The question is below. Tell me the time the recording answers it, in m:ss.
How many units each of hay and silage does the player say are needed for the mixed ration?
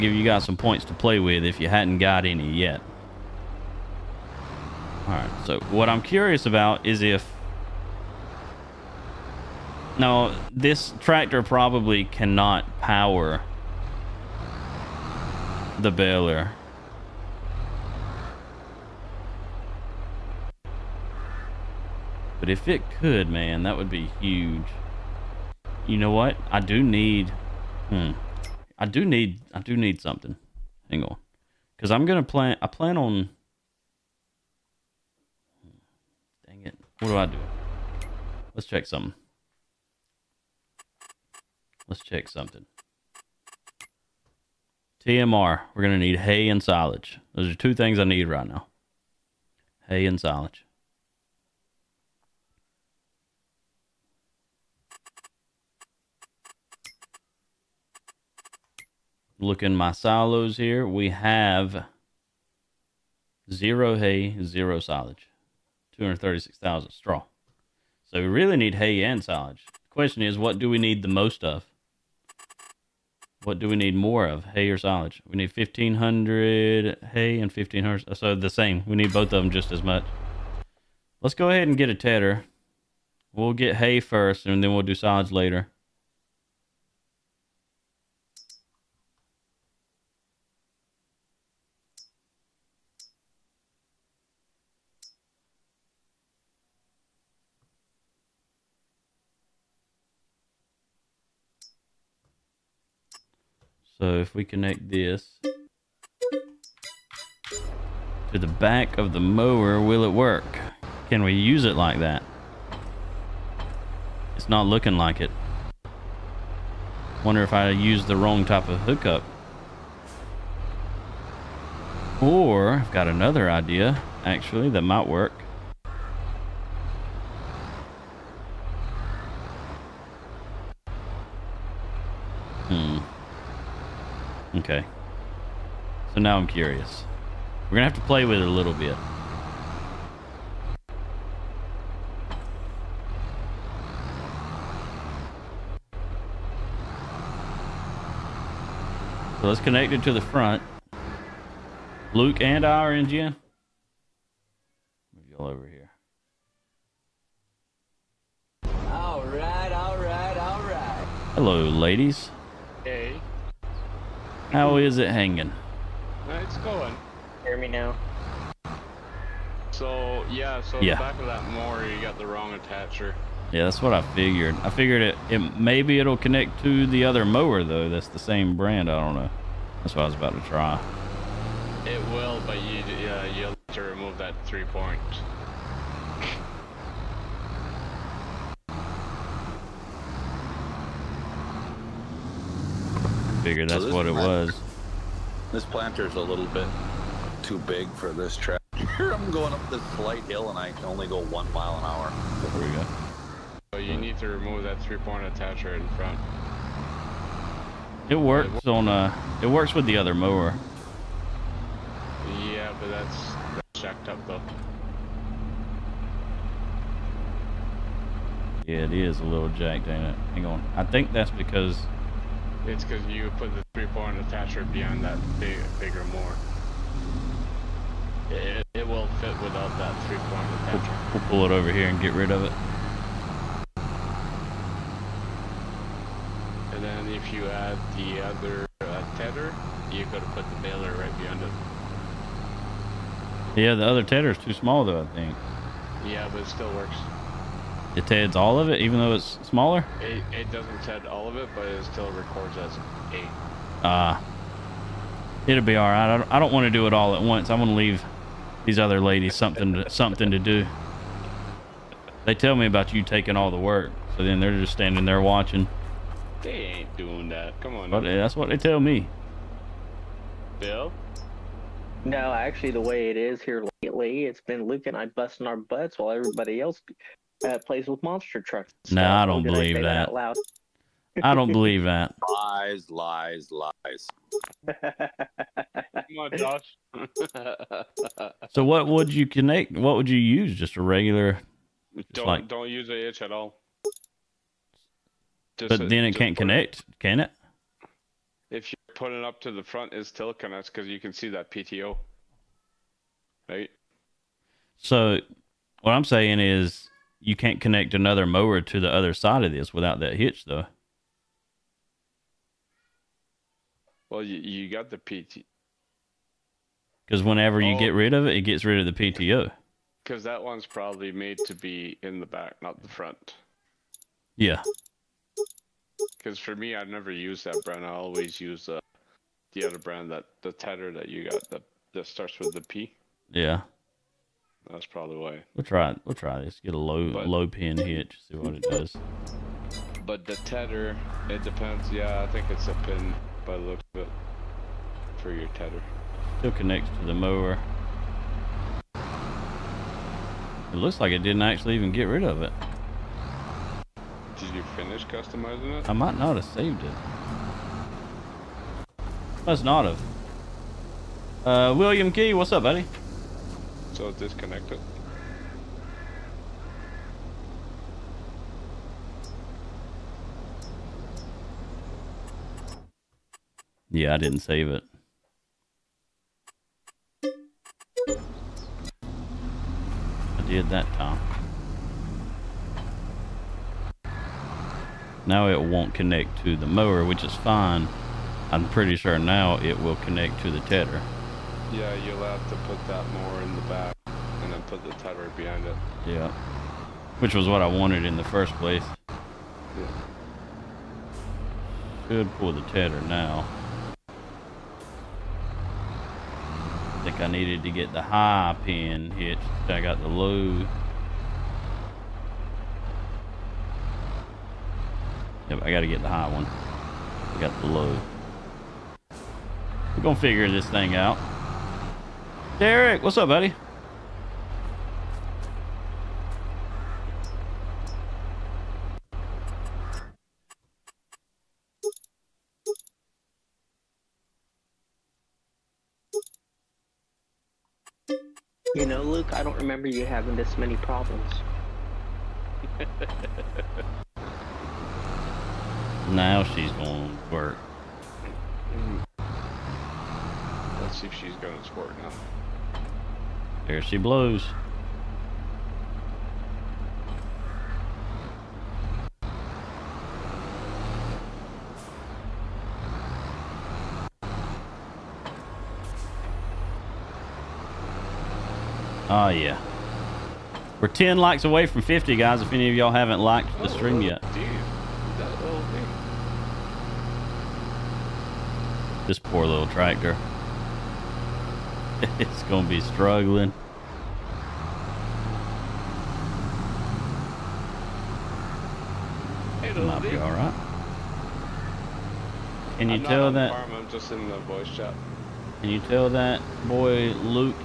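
1:15.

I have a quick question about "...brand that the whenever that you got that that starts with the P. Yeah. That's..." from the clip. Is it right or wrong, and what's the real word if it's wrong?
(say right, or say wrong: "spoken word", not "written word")
wrong: "tedder", not "whenever".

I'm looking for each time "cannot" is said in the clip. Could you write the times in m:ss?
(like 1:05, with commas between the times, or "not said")
0:12.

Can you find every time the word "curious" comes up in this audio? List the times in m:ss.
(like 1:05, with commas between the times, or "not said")
0:06, 2:16.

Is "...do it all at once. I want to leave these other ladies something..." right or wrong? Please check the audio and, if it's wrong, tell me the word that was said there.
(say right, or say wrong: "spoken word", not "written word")
right.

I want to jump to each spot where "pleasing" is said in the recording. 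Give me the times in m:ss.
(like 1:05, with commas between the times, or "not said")
not said.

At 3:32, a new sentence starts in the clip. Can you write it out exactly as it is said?
Yeah, but that's, that's jacked up though.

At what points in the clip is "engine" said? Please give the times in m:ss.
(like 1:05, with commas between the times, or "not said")
2:32.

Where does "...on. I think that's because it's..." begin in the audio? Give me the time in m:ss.
3:40.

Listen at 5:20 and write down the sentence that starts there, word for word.
Because that one's probably made to be in the back, not the front.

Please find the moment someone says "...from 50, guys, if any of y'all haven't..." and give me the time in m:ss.
7:51.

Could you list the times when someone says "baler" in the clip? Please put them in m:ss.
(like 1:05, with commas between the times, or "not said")
0:15, 4:00.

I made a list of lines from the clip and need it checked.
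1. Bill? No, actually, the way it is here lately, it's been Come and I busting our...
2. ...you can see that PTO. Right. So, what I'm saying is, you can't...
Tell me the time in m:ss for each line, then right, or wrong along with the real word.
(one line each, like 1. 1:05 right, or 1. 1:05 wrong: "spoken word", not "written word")
1. 4:30 wrong: "Luke", not "Come"
2. 5:00 right.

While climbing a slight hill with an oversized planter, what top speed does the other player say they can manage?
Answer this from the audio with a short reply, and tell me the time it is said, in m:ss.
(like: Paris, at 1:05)
1 mile an hour, at 3:21.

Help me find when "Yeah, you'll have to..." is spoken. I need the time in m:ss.
6:31.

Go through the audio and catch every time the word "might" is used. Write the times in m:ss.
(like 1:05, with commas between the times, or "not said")
2:04, 5:55, 8:09.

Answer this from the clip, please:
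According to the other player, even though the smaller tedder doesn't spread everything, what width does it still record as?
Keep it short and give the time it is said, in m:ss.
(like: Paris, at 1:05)
8, at 4:13.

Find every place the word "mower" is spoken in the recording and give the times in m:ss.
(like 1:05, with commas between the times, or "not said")
1:49, 2:51, 2:57, 3:30, 5:08, 5:47, 6:26.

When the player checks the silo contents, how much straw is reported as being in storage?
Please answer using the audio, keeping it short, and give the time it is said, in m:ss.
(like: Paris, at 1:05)
236,000, at 1:05.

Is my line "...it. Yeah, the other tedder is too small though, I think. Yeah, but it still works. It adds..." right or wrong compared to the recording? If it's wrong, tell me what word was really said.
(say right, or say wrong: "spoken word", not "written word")
right.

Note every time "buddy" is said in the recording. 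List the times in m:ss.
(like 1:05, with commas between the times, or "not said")
6:02, 7:03.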